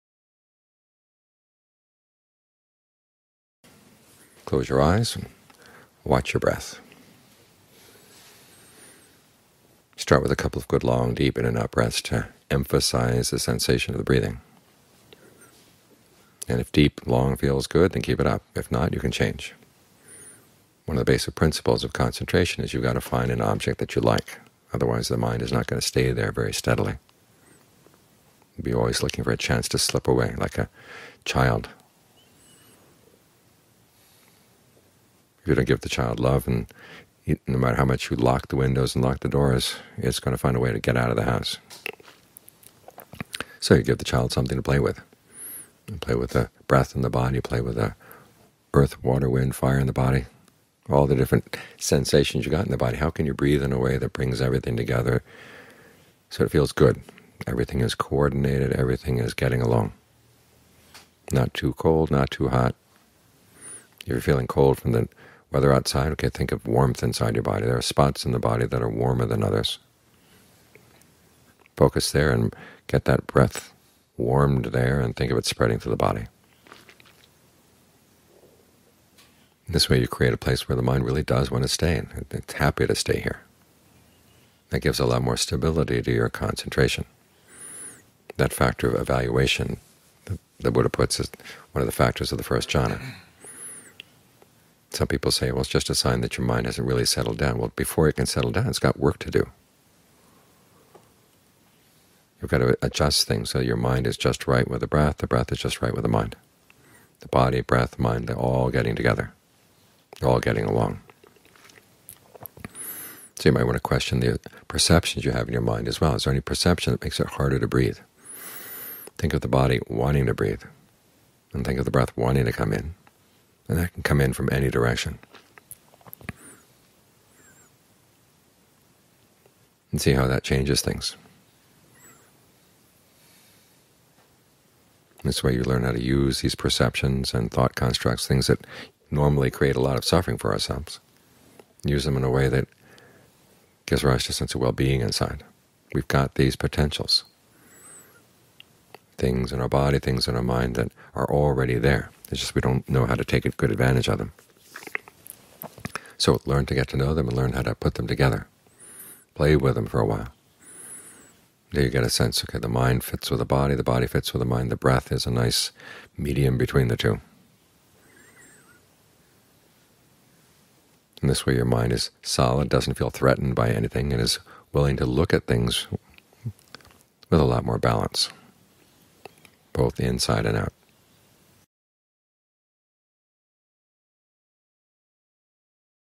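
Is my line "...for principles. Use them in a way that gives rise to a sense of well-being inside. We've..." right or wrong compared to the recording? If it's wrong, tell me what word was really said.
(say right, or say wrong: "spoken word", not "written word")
wrong: "ourselves", not "principles".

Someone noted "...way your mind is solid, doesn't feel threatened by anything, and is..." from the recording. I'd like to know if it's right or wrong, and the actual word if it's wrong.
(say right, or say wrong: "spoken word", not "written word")
right.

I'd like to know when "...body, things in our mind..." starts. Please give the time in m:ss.
2:29.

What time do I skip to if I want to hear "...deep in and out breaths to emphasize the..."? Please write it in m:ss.
0:11.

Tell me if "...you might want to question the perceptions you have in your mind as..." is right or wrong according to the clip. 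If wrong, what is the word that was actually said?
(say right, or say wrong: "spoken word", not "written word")
right.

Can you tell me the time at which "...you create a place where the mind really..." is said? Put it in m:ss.
1:20.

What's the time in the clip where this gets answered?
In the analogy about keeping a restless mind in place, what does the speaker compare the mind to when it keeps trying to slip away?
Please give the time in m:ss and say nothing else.
0:30.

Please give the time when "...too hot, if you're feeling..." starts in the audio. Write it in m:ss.
1:02.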